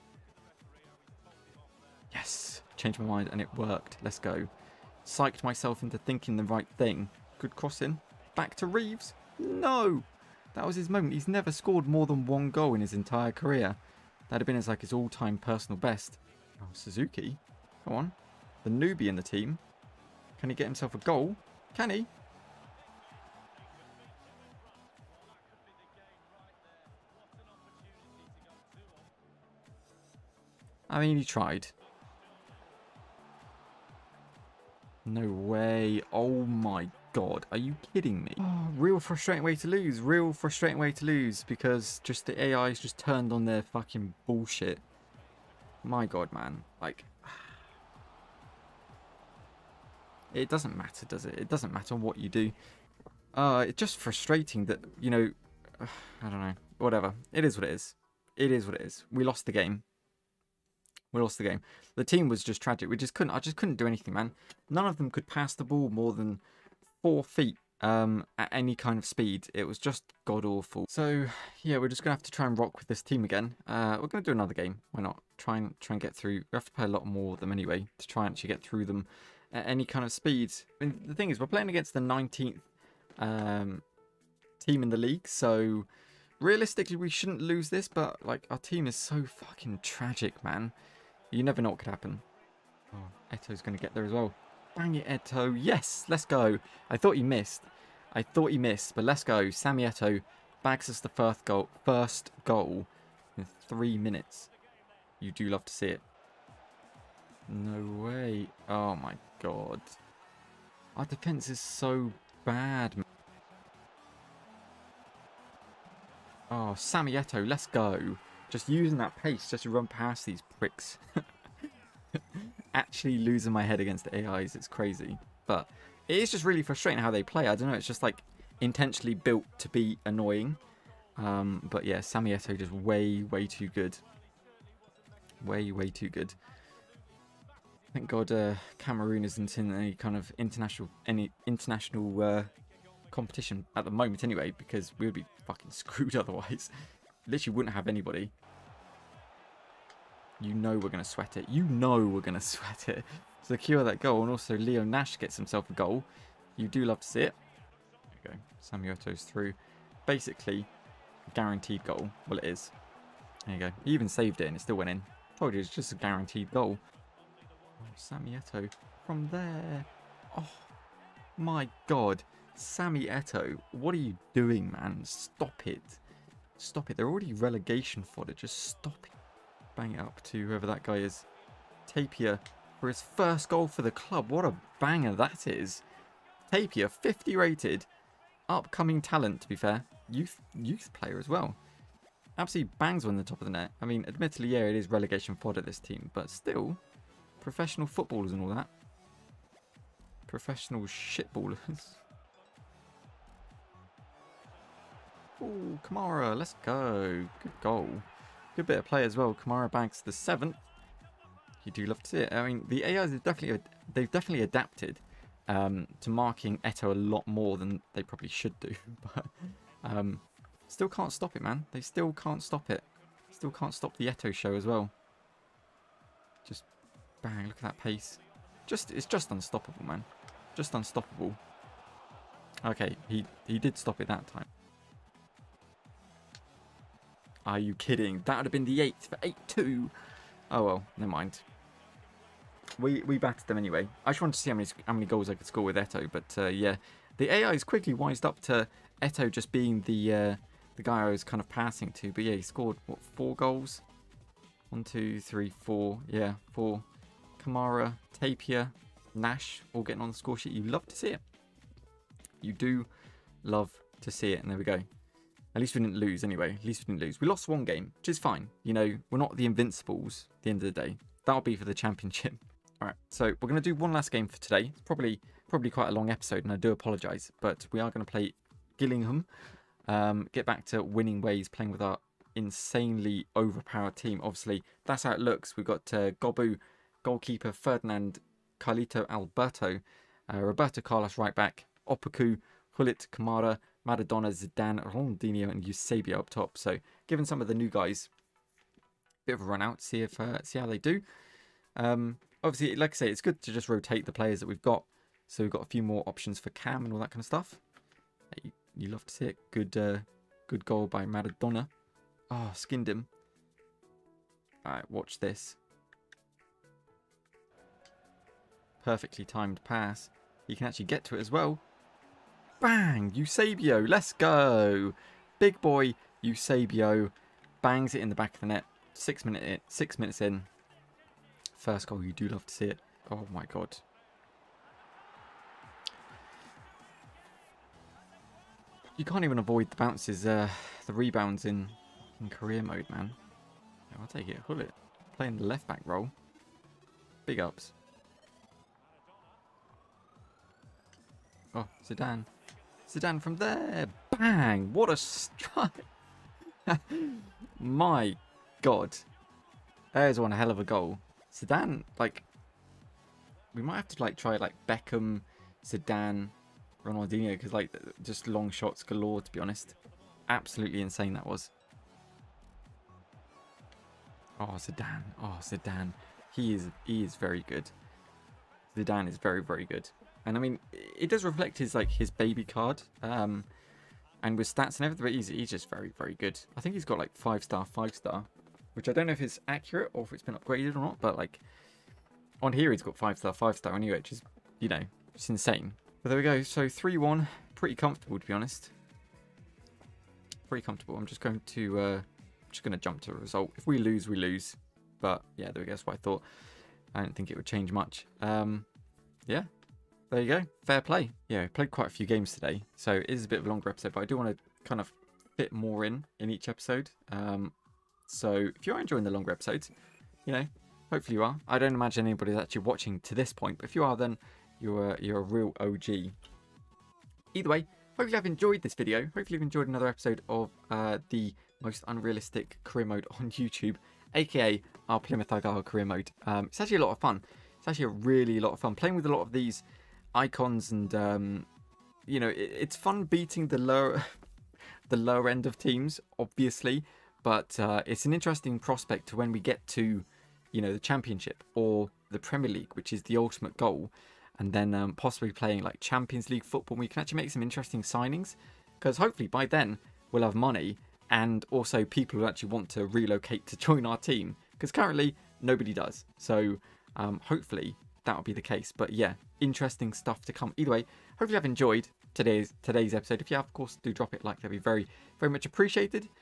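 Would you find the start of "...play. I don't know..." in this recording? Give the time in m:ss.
2:07.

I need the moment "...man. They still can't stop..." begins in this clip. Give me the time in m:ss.
3:41.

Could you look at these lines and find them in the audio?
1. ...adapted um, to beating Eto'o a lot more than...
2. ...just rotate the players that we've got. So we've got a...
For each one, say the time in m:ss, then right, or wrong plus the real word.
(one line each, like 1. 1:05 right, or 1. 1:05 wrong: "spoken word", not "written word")
1. 3:34 wrong: "marking", not "beating"
2. 5:03 right.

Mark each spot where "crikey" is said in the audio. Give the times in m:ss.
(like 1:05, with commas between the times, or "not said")
not said.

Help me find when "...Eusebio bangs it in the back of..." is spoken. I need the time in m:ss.
5:26.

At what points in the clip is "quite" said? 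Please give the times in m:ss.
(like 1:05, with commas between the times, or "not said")
4:35, 6:51.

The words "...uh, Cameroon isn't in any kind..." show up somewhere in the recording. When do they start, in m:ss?
2:18.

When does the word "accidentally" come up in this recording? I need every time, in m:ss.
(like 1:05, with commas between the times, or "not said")
not said.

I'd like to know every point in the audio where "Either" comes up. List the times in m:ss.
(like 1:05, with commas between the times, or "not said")
7:07, 7:50.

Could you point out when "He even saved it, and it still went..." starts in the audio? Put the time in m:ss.
2:43.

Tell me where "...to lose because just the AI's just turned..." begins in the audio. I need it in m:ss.
0:40.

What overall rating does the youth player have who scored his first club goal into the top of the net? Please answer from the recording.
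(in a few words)
50.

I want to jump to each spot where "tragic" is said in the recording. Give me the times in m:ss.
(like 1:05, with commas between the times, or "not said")
1:02, 1:29.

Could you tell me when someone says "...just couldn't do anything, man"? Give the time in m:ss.
1:03.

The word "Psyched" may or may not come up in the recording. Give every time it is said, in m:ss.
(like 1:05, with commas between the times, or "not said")
0:05.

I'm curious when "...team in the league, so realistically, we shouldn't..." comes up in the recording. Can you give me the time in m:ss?
1:24.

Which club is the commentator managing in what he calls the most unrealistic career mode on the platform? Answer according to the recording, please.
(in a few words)
Plymouth Argyle.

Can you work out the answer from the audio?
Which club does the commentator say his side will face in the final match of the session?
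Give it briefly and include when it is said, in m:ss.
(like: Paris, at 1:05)
Gillingham, at 4:38.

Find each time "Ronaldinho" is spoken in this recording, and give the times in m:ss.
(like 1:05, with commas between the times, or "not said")
4:54, 6:06.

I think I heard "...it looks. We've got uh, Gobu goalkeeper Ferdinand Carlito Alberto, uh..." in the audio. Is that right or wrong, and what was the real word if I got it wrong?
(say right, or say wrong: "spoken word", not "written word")
right.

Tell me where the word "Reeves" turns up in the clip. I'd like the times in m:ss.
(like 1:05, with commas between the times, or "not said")
0:08.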